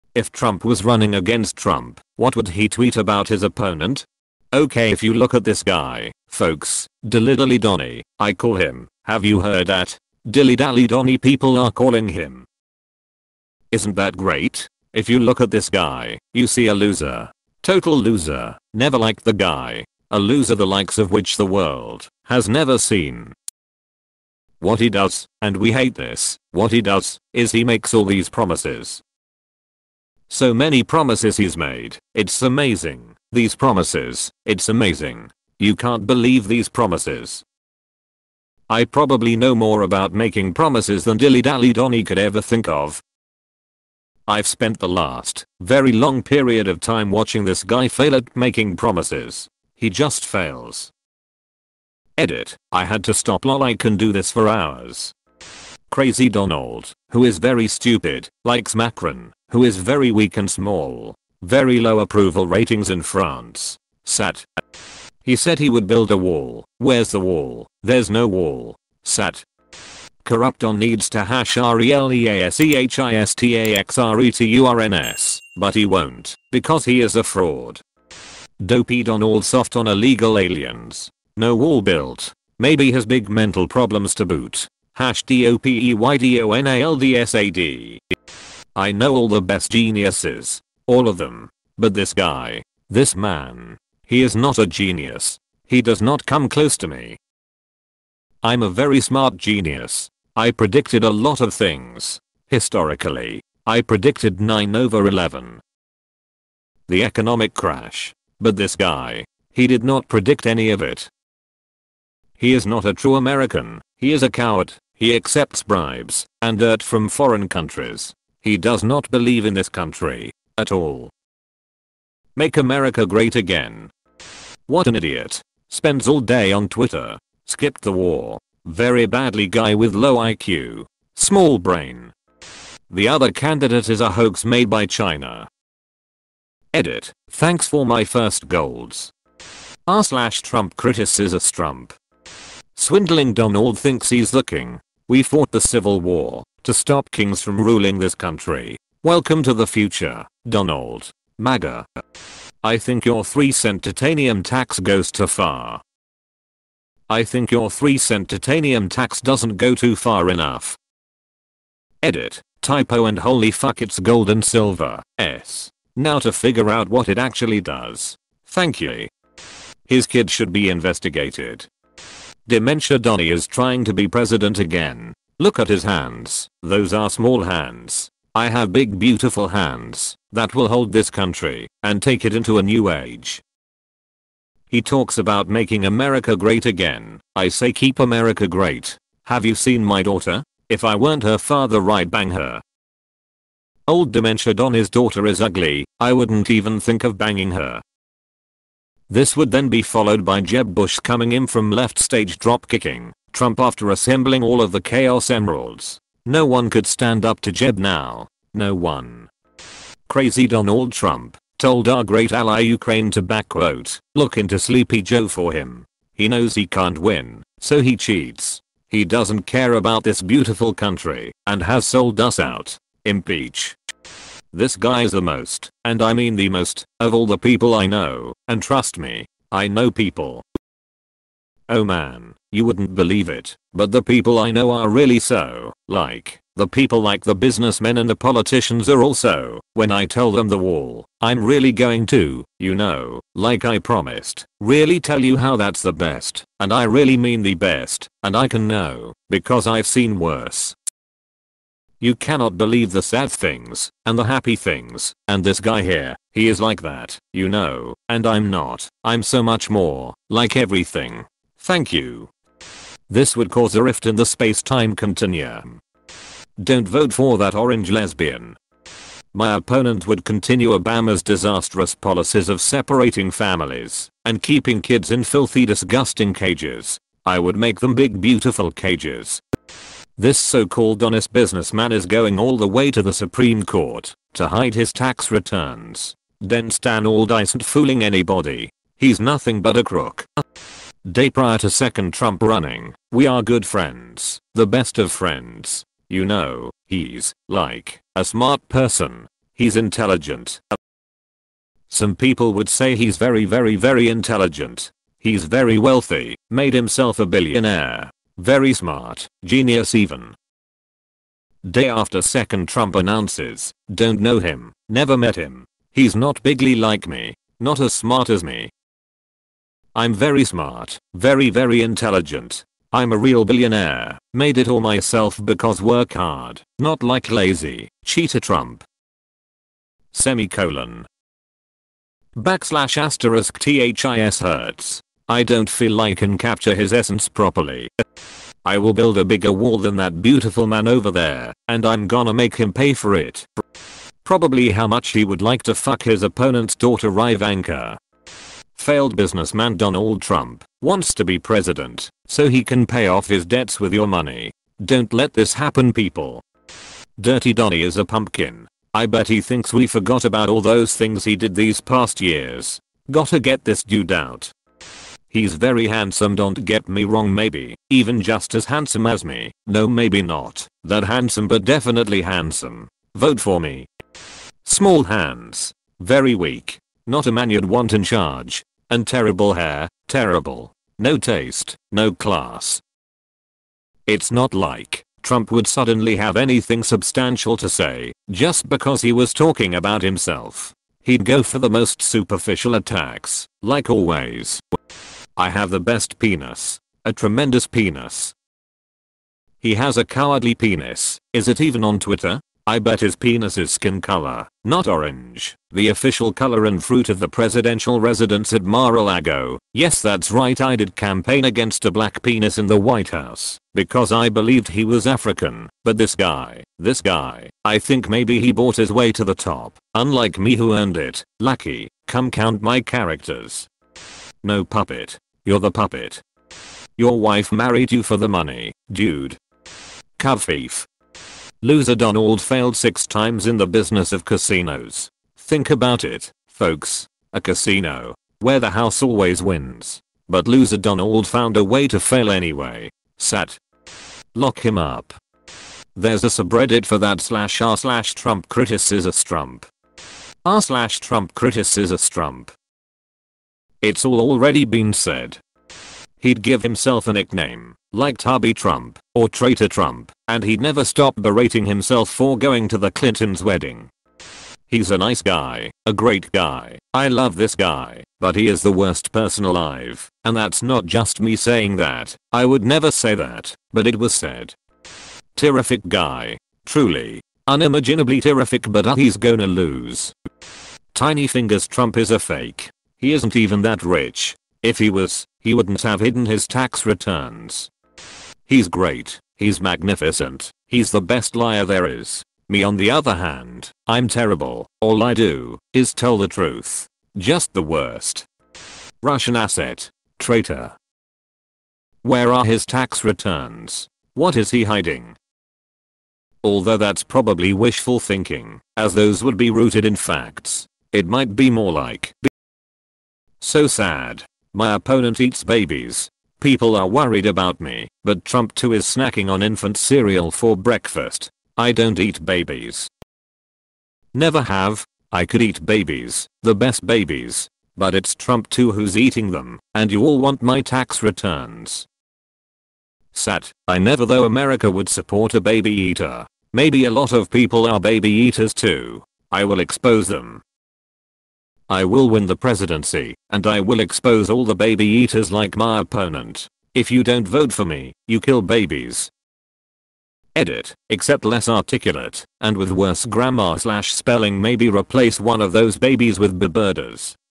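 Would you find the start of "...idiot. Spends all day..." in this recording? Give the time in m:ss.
2:04.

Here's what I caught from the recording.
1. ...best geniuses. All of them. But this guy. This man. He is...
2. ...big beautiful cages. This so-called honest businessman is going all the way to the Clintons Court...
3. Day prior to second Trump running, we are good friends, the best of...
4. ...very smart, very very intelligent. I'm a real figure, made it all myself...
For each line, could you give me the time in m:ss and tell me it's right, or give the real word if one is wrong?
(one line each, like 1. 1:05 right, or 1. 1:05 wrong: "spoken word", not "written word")
1. 1:29 right
2. 4:37 wrong: "Supreme", not "Clintons"
3. 4:51 right
4. 5:20 wrong: "billionaire", not "figure".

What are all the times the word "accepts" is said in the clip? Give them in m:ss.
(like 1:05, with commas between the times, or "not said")
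1:55.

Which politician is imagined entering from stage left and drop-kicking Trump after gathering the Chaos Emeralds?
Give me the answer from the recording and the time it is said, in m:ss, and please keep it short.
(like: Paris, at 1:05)
Jeb Bush, at 3:20.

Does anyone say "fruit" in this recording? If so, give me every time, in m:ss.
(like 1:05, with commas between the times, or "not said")
6:46.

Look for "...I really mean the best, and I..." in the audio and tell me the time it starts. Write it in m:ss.
4:06.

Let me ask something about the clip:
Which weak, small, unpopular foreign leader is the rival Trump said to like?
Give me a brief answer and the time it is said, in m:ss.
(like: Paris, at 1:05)
Macron, at 0:58.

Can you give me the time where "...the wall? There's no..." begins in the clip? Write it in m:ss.
1:07.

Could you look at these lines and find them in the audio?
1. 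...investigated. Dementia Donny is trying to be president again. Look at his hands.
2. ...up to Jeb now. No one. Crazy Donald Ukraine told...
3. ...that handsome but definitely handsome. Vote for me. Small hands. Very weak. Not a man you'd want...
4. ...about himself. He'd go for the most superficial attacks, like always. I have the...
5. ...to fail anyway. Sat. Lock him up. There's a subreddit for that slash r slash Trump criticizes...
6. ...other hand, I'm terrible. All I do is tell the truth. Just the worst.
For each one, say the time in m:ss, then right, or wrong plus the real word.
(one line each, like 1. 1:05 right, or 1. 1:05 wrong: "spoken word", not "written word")
1. 2:50 right
2. 3:27 wrong: "Trump", not "Ukraine"
3. 6:10 right
4. 6:29 right
5. 7:21 right
6. 8:12 right.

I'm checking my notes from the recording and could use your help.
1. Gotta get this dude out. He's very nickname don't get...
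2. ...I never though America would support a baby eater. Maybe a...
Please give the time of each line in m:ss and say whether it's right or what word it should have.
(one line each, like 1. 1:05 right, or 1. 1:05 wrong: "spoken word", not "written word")
1. 6:03 wrong: "handsome", not "nickname"
2. 8:53 right.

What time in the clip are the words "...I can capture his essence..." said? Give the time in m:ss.
5:36.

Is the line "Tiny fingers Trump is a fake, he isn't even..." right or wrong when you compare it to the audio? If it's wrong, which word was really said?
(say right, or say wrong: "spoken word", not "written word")
right.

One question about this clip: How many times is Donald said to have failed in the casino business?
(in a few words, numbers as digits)
6.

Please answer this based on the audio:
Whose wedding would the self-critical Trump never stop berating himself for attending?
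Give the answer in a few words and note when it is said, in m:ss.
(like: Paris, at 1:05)
The Clintons', at 7:42.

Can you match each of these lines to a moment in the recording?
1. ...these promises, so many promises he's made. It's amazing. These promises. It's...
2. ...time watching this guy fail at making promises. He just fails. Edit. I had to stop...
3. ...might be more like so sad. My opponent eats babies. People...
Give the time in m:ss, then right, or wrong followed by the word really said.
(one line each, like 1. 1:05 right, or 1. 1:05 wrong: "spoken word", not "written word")
1. 0:28 right
2. 0:46 right
3. 8:31 right.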